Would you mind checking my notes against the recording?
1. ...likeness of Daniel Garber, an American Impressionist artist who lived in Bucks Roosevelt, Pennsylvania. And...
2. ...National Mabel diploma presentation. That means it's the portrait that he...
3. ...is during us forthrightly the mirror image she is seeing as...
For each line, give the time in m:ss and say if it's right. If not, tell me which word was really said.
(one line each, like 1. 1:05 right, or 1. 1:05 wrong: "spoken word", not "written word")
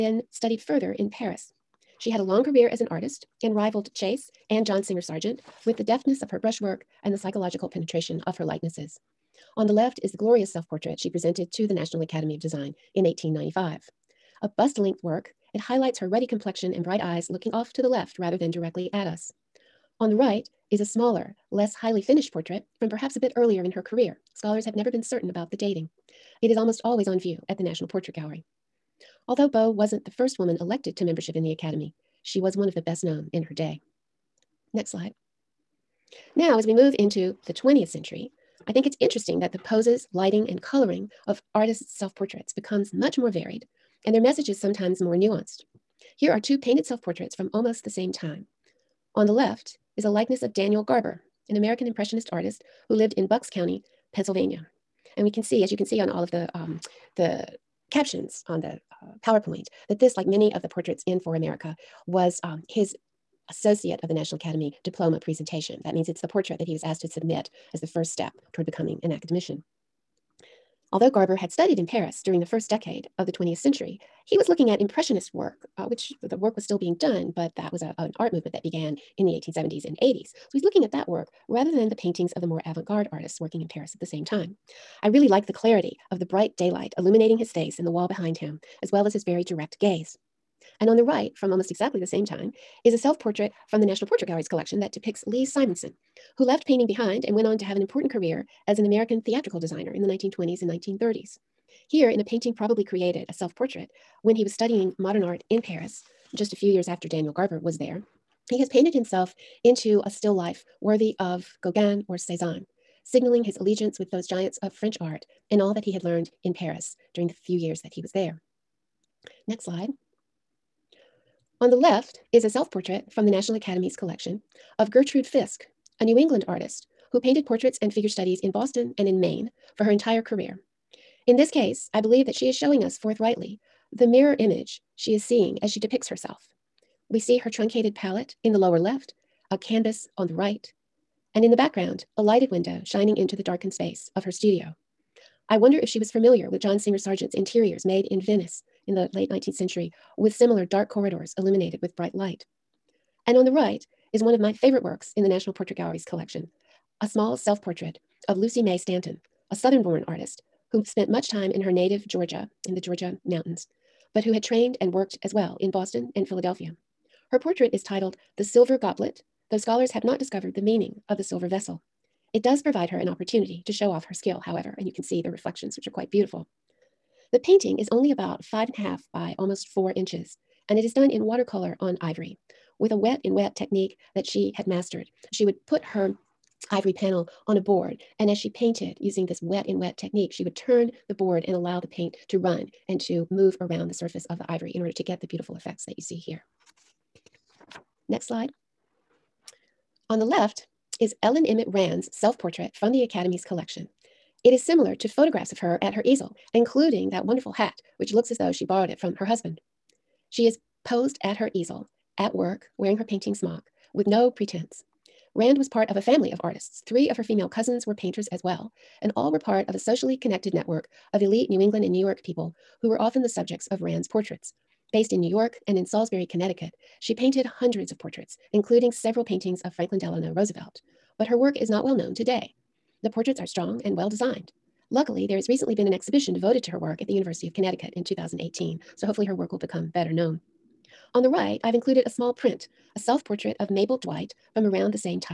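1. 0:50 wrong: "County", not "Roosevelt"
2. 1:04 wrong: "Academy", not "Mabel"
3. 2:12 wrong: "showing", not "during".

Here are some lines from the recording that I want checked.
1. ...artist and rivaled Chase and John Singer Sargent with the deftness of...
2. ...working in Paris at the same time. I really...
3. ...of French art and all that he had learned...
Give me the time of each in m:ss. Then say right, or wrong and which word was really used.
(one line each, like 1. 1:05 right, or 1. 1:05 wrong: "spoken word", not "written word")
1. 0:02 right
2. 1:23 right
3. 1:54 right.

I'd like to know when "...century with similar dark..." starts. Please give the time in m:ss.
2:29.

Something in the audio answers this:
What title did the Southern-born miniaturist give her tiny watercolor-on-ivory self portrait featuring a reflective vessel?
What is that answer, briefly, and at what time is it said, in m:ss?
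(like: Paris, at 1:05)
The Silver Goblet, at 2:48.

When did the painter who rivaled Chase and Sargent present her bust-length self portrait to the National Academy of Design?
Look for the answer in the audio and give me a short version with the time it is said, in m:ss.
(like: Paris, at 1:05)
1895, at 0:13.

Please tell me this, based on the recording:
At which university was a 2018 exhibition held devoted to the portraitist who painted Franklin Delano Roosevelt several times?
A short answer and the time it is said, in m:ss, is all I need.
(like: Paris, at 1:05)
University of Connecticut, at 3:57.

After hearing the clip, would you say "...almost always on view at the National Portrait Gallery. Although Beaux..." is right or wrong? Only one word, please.
right.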